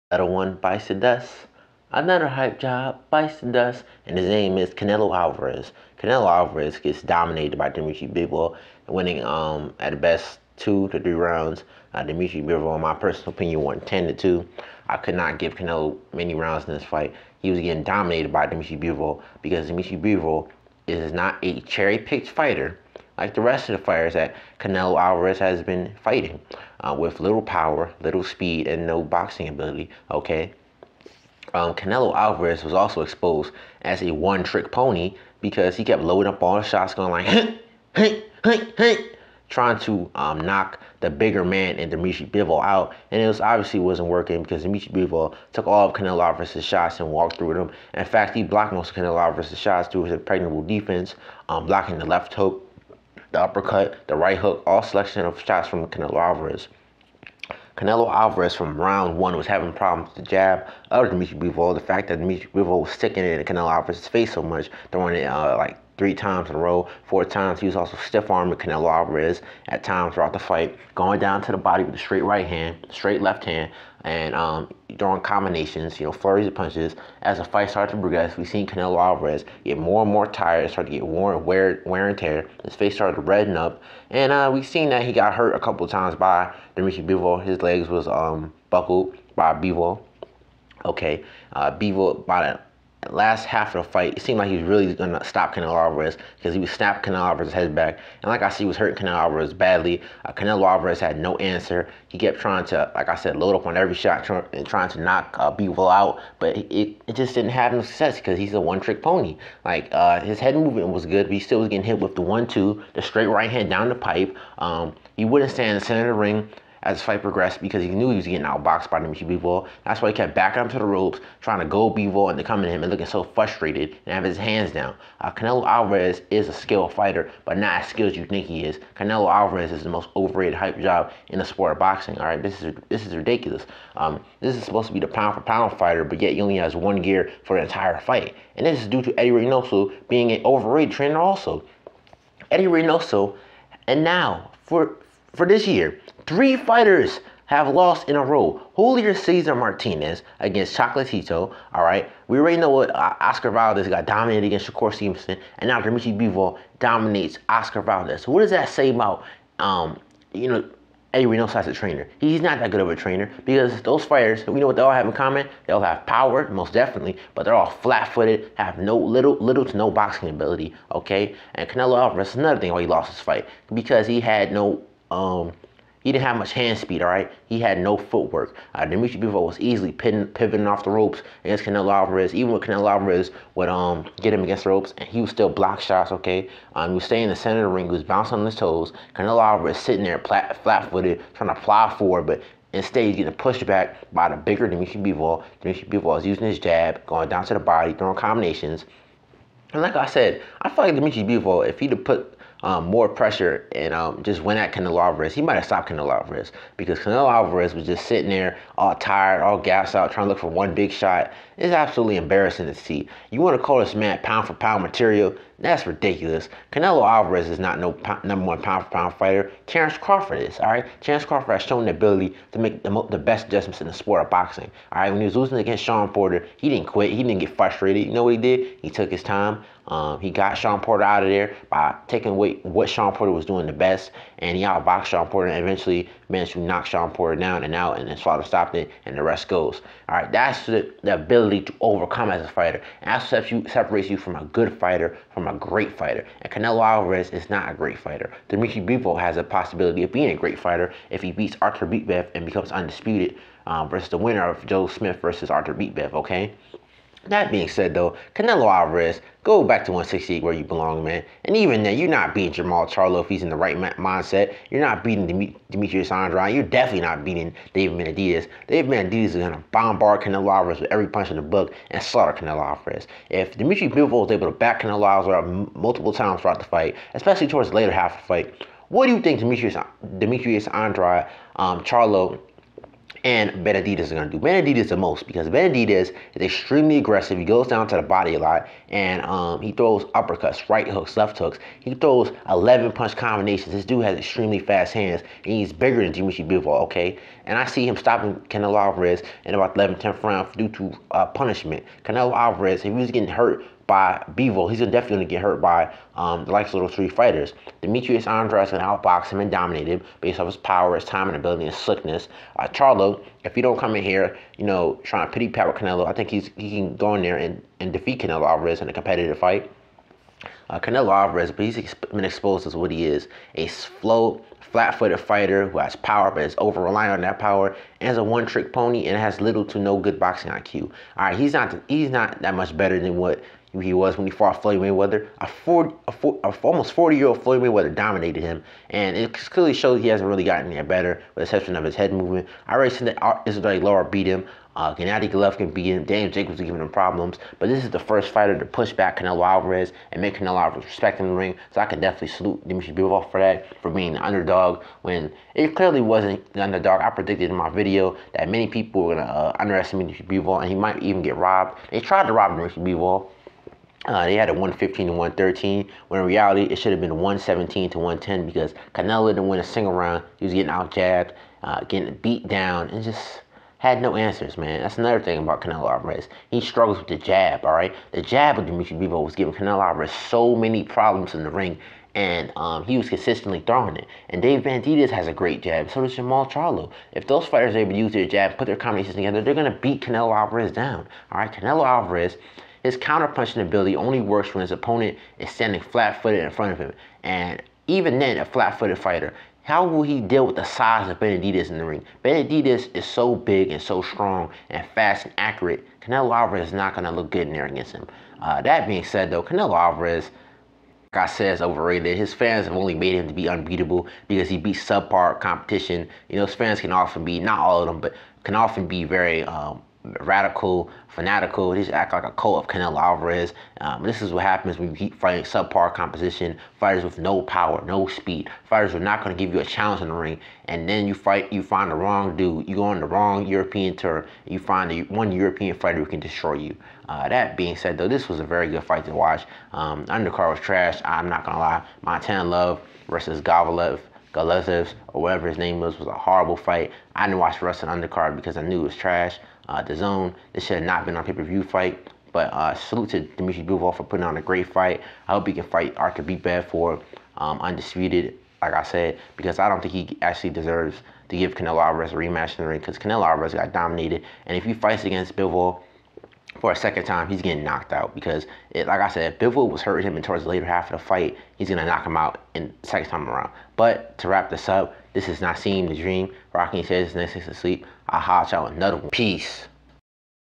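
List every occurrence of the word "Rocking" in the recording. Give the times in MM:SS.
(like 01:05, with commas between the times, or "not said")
07:56.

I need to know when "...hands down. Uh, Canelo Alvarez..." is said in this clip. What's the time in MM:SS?
02:04.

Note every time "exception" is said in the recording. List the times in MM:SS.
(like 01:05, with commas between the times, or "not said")
05:41.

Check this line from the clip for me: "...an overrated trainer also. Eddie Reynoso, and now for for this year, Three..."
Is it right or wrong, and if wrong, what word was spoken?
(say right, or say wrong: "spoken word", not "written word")
right.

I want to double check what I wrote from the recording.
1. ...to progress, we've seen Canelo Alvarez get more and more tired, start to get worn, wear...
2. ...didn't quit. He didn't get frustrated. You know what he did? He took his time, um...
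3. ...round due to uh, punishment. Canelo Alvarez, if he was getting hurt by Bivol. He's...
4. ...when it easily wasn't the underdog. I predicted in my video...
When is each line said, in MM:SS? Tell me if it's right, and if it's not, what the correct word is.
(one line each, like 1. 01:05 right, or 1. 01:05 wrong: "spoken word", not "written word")
1. 01:17 right
2. 03:46 right
3. 05:00 right
4. 05:55 wrong: "clearly", not "easily".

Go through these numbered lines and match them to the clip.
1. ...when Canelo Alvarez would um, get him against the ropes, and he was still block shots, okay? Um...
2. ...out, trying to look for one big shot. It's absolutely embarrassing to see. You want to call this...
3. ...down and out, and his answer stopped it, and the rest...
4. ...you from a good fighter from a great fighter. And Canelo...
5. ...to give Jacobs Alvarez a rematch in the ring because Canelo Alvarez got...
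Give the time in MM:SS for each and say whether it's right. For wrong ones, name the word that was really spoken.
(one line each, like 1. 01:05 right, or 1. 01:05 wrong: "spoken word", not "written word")
1. 03:02 right
2. 03:29 right
3. 03:57 wrong: "father", not "answer"
4. 04:04 right
5. 07:41 wrong: "Canelo", not "Jacobs".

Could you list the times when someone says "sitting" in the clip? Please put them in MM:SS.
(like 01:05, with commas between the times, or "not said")
03:09, 03:28.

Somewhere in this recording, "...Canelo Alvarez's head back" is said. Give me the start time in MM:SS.
01:37.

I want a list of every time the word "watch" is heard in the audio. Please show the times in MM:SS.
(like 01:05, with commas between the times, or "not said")
07:19, 07:27.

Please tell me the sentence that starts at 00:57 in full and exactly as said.
Canelo Alvarez from round one was having problems with the jab of Dimitri Bivol.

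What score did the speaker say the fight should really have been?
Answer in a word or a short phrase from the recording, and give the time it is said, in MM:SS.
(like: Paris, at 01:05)
117 to 110, at 06:07.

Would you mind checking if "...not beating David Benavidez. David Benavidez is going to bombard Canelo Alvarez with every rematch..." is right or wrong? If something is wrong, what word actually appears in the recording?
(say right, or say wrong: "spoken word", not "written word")
wrong: "punch", not "rematch".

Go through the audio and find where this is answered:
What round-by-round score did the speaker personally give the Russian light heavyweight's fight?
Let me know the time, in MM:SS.
00:13.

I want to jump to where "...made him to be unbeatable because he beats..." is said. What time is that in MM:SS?
06:52.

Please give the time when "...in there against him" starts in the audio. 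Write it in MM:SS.
06:47.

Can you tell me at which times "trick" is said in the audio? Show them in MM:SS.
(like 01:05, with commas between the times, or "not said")
00:34, 01:48, 05:28.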